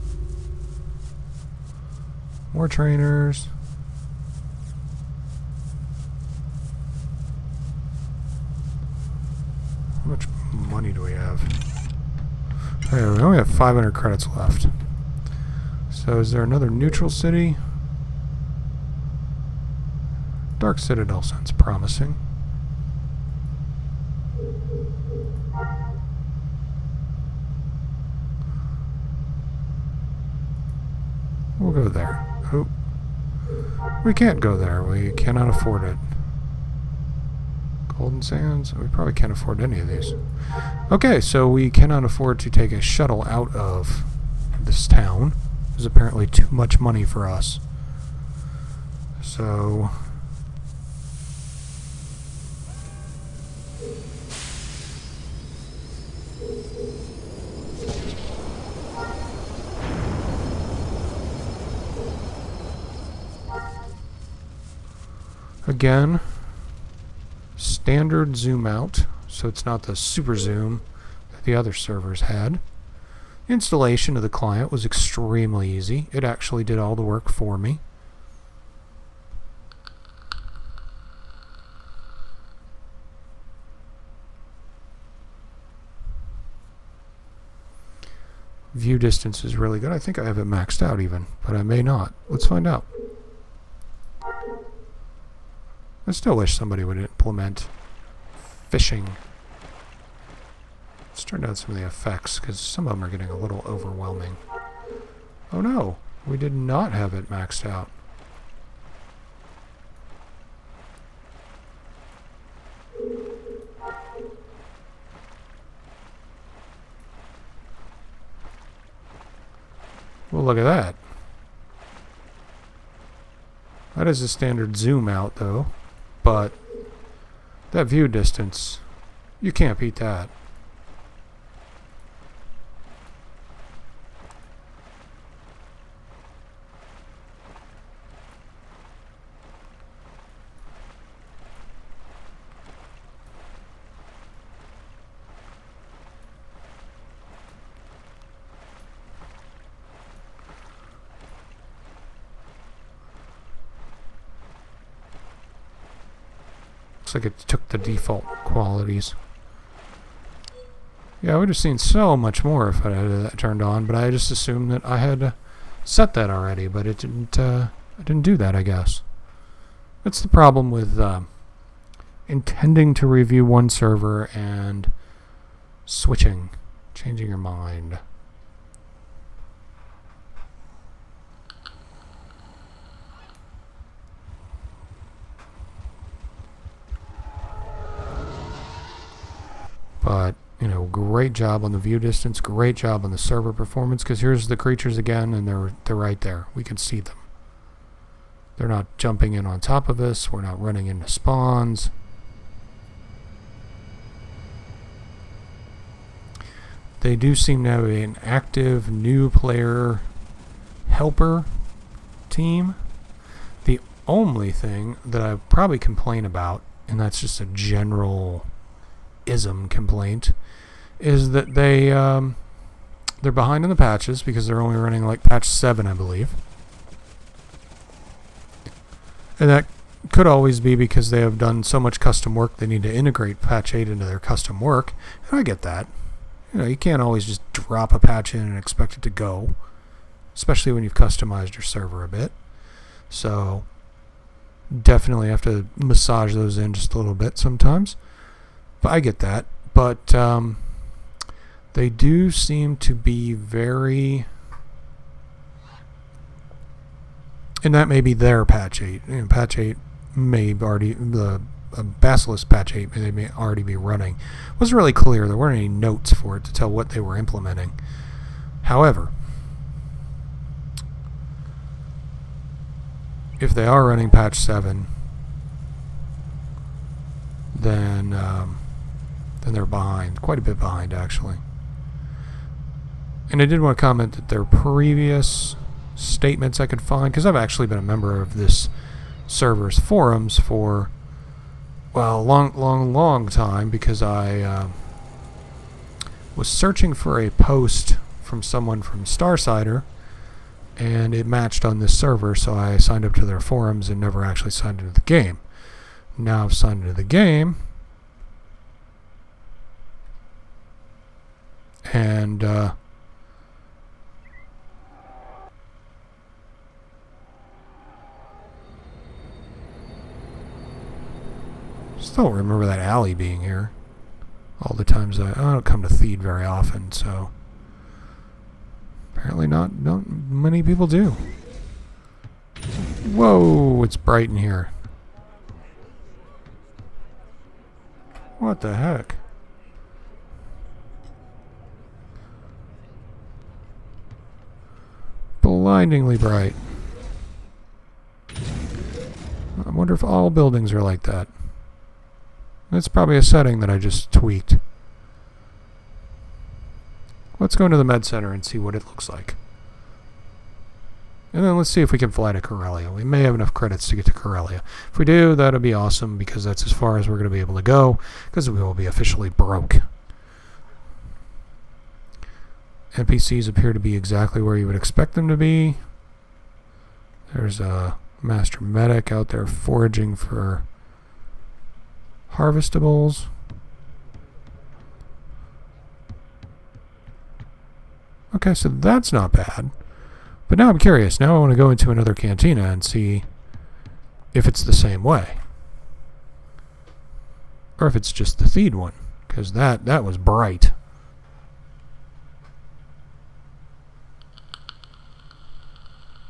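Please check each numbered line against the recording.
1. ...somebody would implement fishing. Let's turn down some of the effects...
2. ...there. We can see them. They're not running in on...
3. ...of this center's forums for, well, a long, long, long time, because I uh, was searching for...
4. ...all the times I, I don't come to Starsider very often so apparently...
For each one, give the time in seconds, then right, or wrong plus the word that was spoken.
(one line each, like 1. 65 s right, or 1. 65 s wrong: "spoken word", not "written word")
1. 96 s right
2. 196 s wrong: "jumping", not "running"
3. 288 s wrong: "server", not "center"
4. 324 s wrong: "Theed", not "Starsider".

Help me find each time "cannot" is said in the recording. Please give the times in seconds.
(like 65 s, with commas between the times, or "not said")
35 s, 41 s.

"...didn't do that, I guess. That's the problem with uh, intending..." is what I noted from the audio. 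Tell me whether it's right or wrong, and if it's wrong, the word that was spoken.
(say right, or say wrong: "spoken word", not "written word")
right.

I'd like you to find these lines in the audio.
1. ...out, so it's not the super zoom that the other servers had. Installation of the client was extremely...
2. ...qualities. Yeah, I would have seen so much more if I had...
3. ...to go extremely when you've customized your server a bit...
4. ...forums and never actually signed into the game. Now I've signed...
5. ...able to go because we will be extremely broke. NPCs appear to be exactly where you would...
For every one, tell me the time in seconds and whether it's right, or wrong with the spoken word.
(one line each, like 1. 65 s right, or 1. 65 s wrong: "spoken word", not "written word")
1. 68 s right
2. 158 s right
3. 239 s wrong: "especially", not "extremely"
4. 303 s right
5. 367 s wrong: "officially", not "extremely".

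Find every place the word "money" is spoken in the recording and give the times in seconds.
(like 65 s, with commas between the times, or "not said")
10 s, 46 s.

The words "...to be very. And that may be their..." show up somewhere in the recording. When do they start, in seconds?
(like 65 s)
252 s.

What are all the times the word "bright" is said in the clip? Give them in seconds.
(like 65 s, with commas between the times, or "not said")
333 s, 346 s, 400 s.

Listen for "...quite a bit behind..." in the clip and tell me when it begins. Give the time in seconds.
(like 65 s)
280 s.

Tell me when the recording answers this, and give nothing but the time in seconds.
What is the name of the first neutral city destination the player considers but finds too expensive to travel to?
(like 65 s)
20 s.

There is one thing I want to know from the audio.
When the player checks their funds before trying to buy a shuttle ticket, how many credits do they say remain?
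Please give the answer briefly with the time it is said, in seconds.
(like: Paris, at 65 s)
500, at 13 s.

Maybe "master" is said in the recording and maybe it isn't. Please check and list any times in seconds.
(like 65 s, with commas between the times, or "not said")
378 s.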